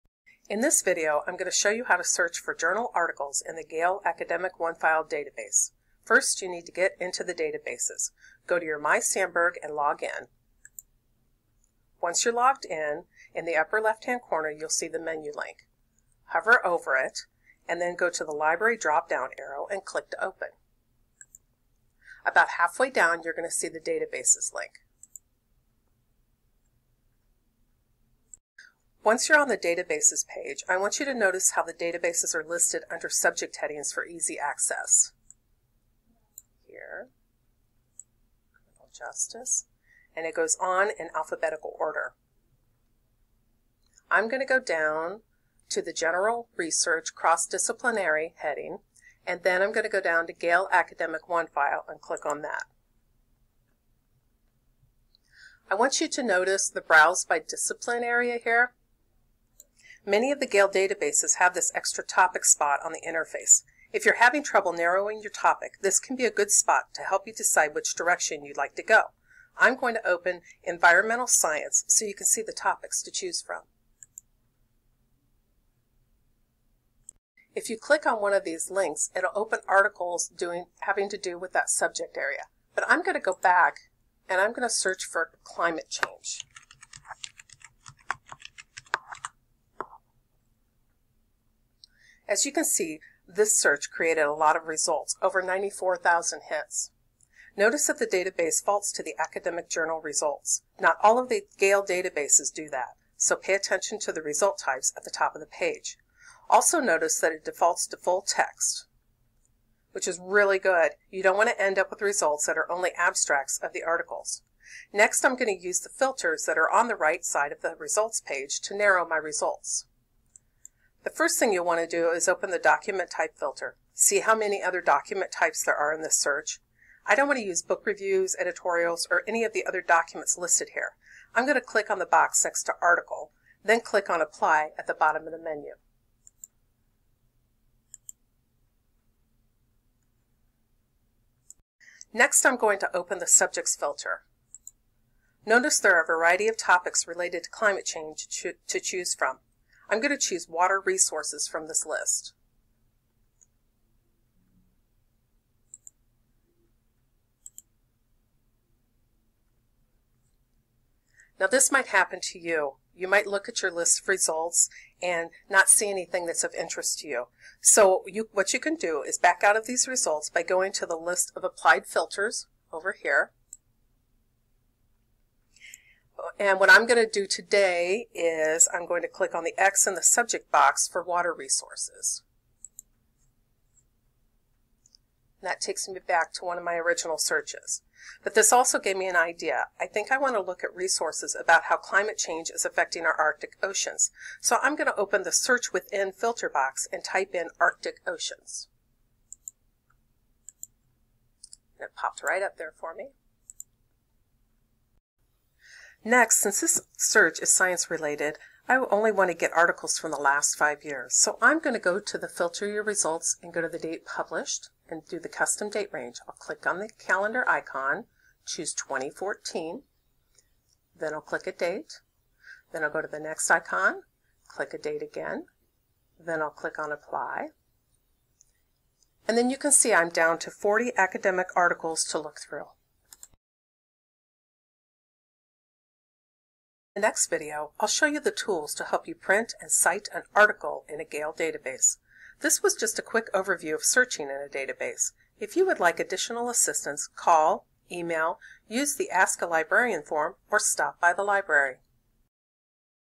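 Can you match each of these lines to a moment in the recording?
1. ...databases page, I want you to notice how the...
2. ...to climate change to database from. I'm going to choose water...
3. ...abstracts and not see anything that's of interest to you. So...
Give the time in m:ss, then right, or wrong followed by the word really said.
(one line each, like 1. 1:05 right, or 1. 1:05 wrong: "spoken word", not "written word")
1. 0:29 right
2. 2:27 wrong: "choose", not "database"
3. 2:44 wrong: "results", not "abstracts".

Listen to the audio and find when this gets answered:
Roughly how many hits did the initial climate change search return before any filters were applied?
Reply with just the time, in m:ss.
1:35.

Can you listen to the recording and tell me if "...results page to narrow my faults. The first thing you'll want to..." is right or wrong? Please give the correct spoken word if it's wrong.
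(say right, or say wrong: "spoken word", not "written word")
wrong: "results", not "faults".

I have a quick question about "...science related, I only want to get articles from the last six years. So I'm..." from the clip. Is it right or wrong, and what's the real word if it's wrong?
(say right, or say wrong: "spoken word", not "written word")
wrong: "five", not "six".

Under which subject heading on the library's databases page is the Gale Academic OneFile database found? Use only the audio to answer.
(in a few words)
General research cross-disciplinary.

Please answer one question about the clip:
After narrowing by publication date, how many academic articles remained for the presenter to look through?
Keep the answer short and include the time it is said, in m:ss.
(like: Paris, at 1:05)
40, at 3:50.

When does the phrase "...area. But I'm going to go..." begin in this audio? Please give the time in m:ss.
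1:22.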